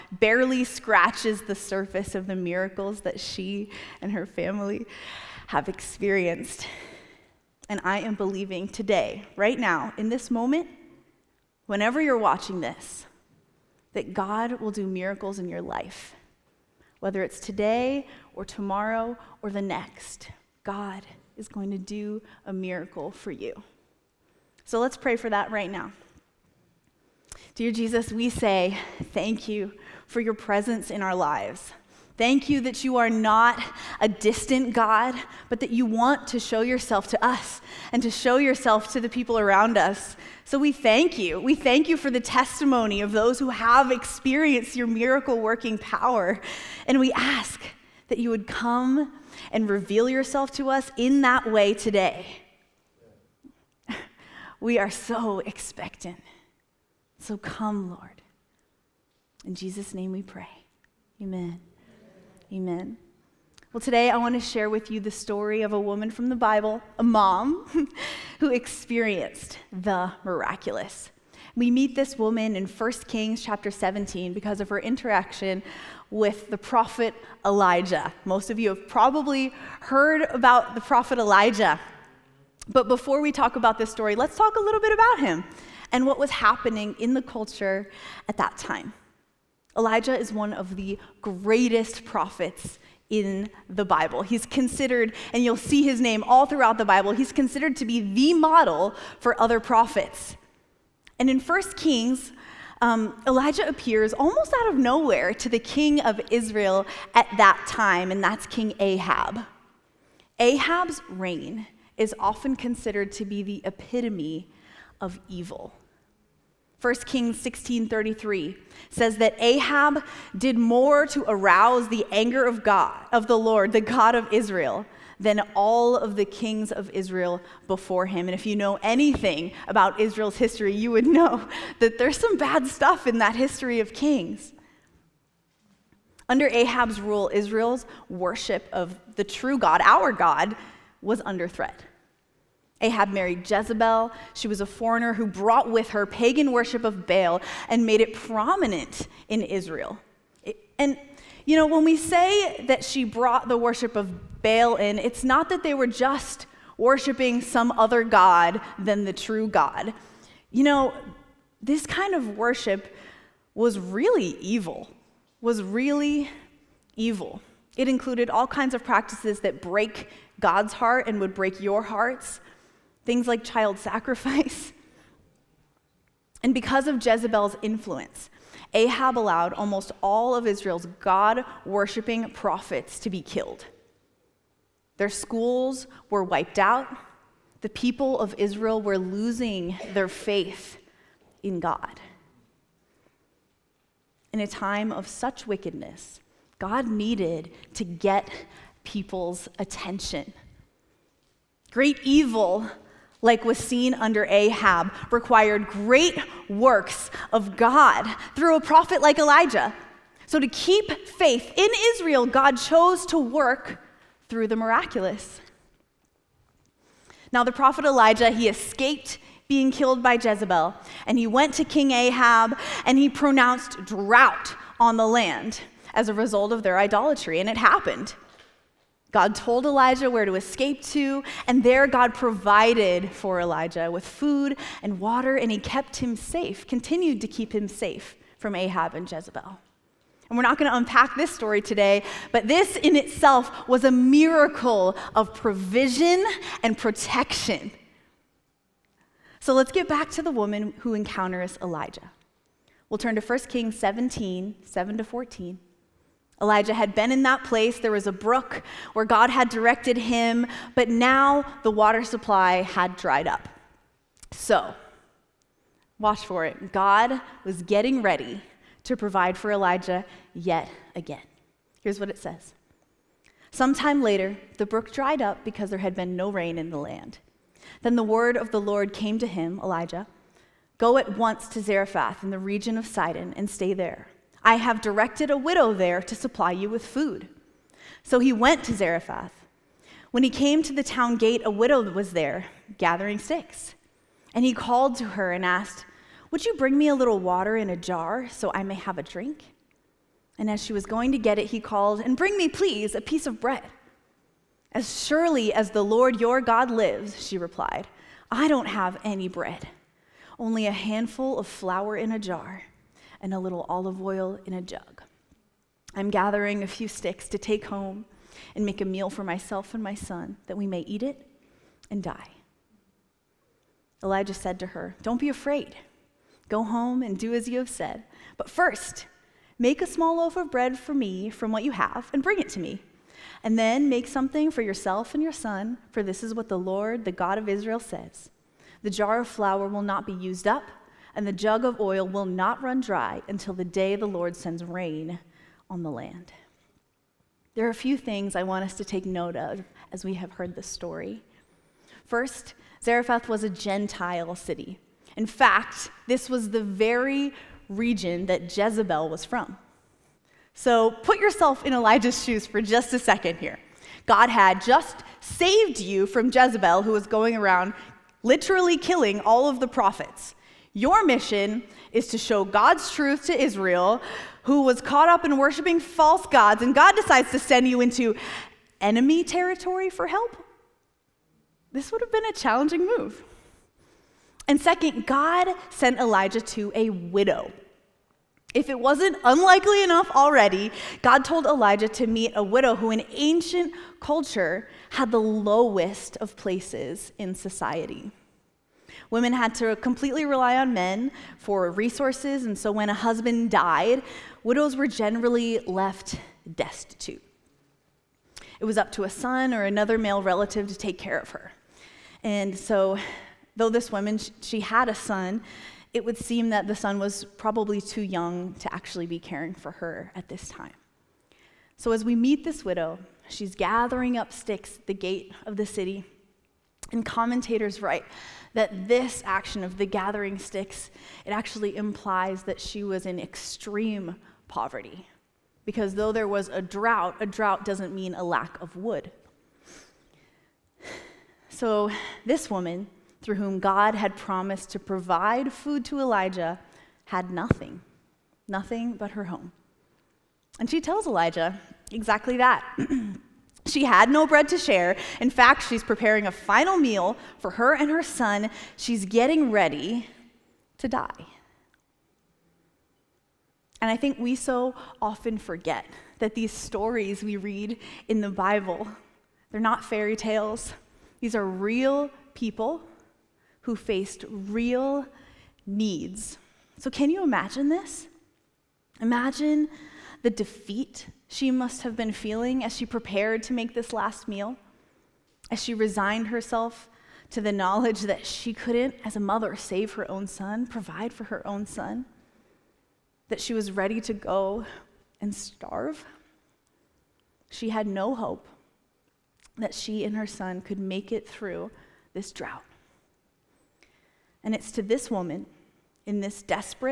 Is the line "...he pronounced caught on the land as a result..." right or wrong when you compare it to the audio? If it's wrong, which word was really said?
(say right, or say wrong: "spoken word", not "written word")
wrong: "drought", not "caught".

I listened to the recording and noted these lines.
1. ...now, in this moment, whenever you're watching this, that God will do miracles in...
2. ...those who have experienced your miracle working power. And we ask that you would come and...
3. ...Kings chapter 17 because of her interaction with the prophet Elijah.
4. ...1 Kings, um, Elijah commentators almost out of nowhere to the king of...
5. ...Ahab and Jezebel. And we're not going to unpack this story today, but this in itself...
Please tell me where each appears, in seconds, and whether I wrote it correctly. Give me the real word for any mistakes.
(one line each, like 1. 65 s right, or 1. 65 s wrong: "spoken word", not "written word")
1. 9 s right
2. 43 s right
3. 73 s right
4. 101 s wrong: "appears", not "commentators"
5. 238 s right.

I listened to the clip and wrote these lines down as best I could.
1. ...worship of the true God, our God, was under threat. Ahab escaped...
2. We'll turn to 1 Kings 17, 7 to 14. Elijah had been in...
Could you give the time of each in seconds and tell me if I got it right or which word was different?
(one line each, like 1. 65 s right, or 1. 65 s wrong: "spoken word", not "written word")
1. 138 s wrong: "married", not "escaped"
2. 252 s right.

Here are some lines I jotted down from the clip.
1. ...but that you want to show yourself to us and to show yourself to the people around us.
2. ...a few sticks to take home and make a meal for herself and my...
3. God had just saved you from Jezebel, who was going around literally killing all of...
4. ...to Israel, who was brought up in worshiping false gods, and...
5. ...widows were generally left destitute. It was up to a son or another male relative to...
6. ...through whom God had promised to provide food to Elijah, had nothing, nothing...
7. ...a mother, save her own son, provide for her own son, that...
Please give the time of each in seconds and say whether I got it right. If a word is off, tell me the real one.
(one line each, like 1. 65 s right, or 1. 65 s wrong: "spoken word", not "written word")
1. 35 s right
2. 316 s wrong: "myself", not "herself"
3. 364 s right
4. 373 s wrong: "caught", not "brought"
5. 404 s right
6. 443 s right
7. 489 s right.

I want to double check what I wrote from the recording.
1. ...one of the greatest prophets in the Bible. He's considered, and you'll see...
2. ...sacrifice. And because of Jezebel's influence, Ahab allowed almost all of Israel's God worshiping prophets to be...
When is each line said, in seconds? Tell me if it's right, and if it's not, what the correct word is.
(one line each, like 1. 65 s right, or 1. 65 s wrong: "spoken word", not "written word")
1. 90 s right
2. 173 s right.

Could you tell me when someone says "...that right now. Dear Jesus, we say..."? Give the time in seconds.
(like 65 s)
25 s.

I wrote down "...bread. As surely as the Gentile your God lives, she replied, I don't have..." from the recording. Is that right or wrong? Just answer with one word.
wrong.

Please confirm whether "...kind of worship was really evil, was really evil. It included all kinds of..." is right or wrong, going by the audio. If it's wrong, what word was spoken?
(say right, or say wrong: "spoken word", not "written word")
right.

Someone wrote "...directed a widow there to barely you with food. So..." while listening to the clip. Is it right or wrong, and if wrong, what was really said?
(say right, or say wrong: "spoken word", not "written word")
wrong: "supply", not "barely".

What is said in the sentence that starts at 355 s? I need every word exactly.
In fact, this was the very region that Jezebel was from.